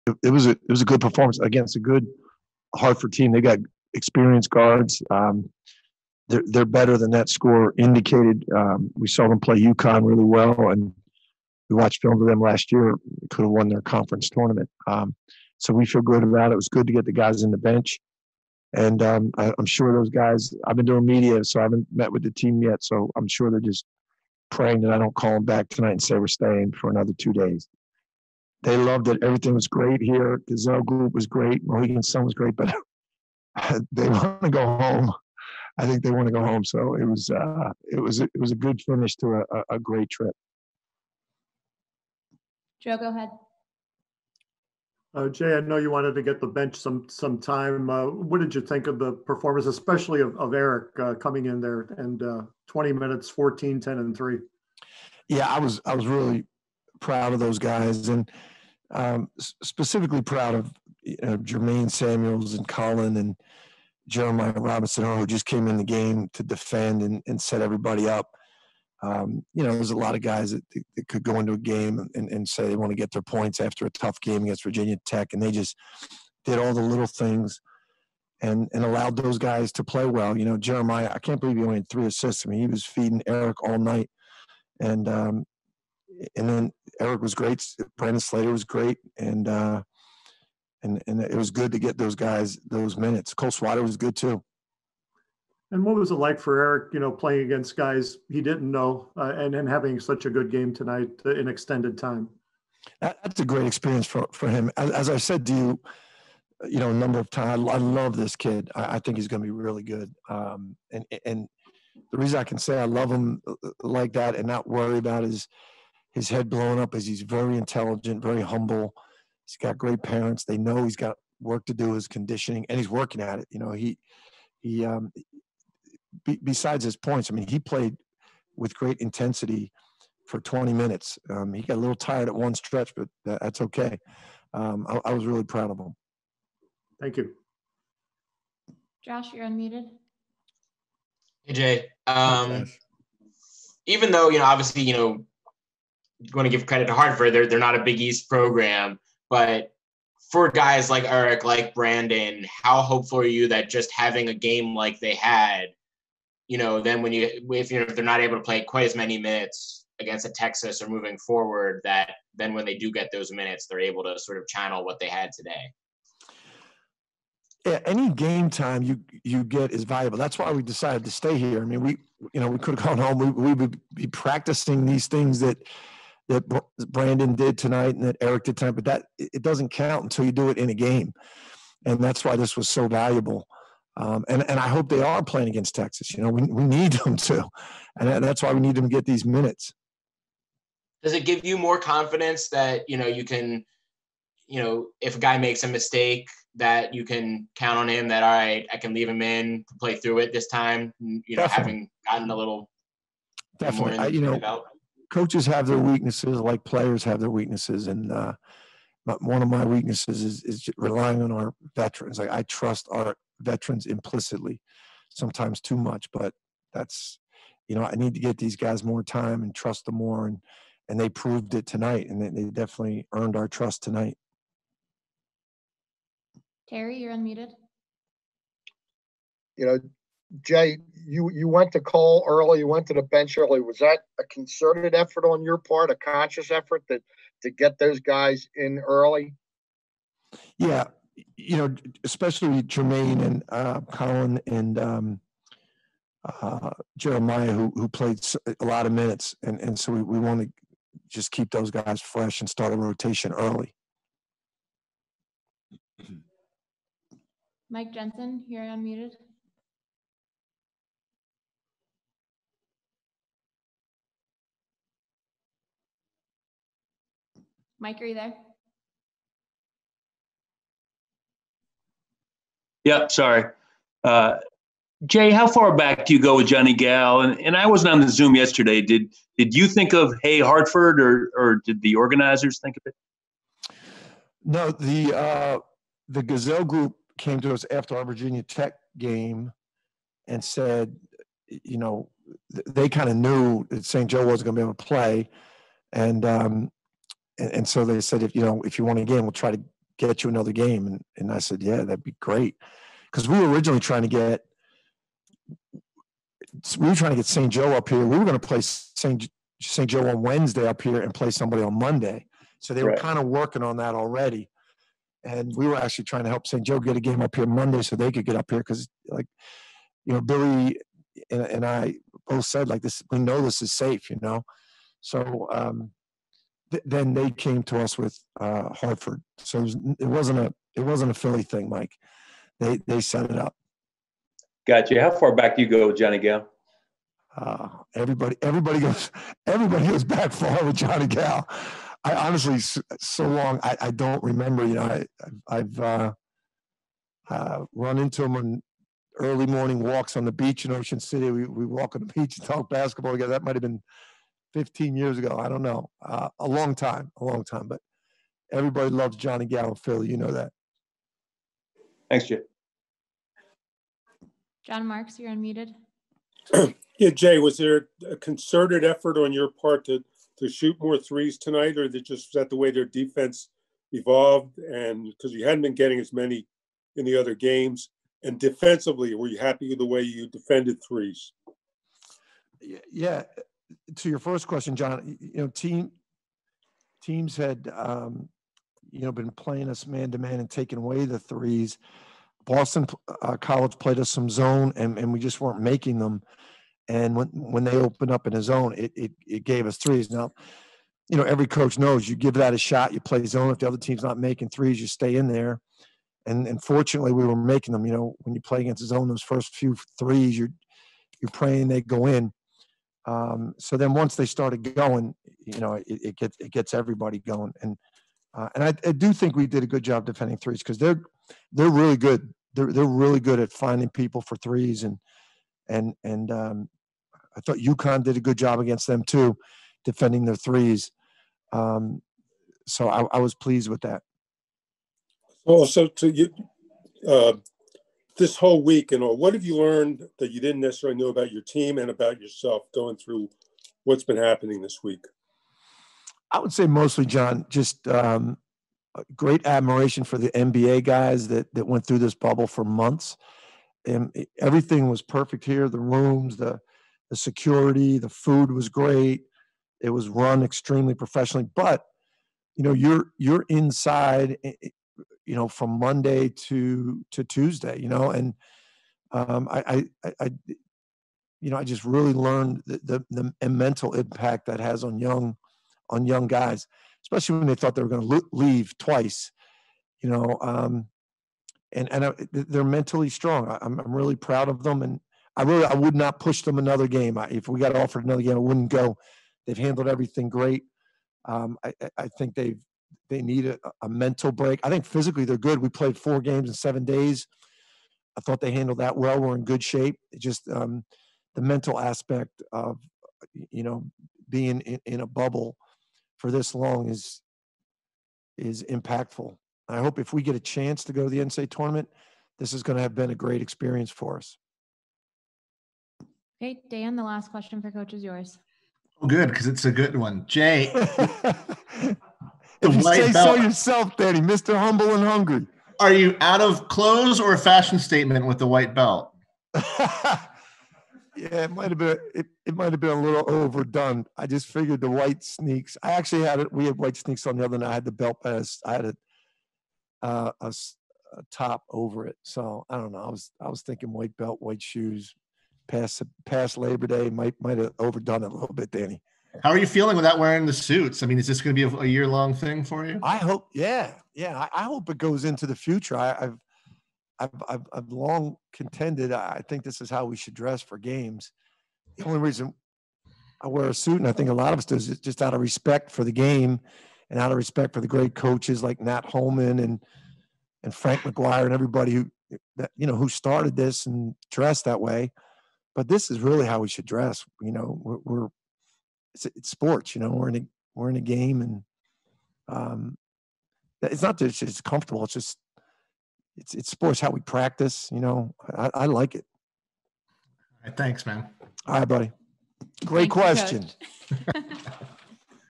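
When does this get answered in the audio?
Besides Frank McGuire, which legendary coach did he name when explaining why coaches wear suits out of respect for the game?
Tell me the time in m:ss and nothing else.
9:28.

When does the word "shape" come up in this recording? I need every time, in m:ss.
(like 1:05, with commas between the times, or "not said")
8:19.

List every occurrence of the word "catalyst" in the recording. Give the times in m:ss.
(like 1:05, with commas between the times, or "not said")
not said.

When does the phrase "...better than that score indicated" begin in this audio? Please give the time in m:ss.
0:06.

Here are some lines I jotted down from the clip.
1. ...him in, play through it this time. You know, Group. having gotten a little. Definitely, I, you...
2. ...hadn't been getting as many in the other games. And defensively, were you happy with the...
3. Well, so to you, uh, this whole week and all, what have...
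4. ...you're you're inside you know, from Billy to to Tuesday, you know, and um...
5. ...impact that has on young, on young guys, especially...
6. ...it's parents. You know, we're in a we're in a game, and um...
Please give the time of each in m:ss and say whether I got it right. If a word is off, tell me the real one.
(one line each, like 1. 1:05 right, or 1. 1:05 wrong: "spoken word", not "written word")
1. 3:19 wrong: "Definitely", not "Group"
2. 6:15 right
3. 7:15 right
4. 7:42 wrong: "Monday", not "Billy"
5. 7:53 right
6. 9:39 wrong: "sports", not "parents".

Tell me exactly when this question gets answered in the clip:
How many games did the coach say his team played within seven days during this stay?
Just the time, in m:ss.
8:15.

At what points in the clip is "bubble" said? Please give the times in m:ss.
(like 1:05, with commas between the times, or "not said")
7:32, 8:25.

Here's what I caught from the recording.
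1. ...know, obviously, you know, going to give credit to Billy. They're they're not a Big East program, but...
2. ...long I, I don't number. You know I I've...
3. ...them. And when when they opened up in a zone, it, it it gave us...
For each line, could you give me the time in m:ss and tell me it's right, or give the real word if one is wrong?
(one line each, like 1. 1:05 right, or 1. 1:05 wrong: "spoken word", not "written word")
1. 2:24 wrong: "Hartford", not "Billy"
2. 5:43 wrong: "remember", not "number"
3. 6:35 right.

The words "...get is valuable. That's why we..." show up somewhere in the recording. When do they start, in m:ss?
2:49.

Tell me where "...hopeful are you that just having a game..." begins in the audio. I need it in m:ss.
2:32.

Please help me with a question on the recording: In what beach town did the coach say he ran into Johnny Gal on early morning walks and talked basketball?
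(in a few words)
Ocean City.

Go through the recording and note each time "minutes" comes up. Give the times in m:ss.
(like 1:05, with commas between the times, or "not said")
0:52, 1:32, 2:10, 2:39, 2:43, 3:09, 4:08.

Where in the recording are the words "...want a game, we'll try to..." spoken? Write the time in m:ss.
4:58.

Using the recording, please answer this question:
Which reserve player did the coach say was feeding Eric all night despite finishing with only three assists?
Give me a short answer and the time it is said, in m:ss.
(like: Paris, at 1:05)
Jeremiah Robinson, at 1:04.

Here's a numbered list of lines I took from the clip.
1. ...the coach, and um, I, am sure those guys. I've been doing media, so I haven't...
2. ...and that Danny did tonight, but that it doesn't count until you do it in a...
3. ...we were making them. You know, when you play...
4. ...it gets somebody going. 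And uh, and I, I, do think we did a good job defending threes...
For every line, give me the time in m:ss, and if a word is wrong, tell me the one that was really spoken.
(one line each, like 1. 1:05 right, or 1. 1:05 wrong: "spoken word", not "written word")
1. 0:17 wrong: "bench", not "coach"
2. 2:57 wrong: "Eric", not "Danny"
3. 6:47 right
4. 6:56 wrong: "everybody", not "somebody".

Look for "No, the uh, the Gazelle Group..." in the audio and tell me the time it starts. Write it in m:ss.
4:44.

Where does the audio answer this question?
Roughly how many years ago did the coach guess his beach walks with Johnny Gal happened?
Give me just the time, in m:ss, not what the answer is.
5:54.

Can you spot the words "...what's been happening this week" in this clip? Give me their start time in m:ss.
7:23.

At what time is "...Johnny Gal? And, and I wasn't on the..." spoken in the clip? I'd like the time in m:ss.
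4:36.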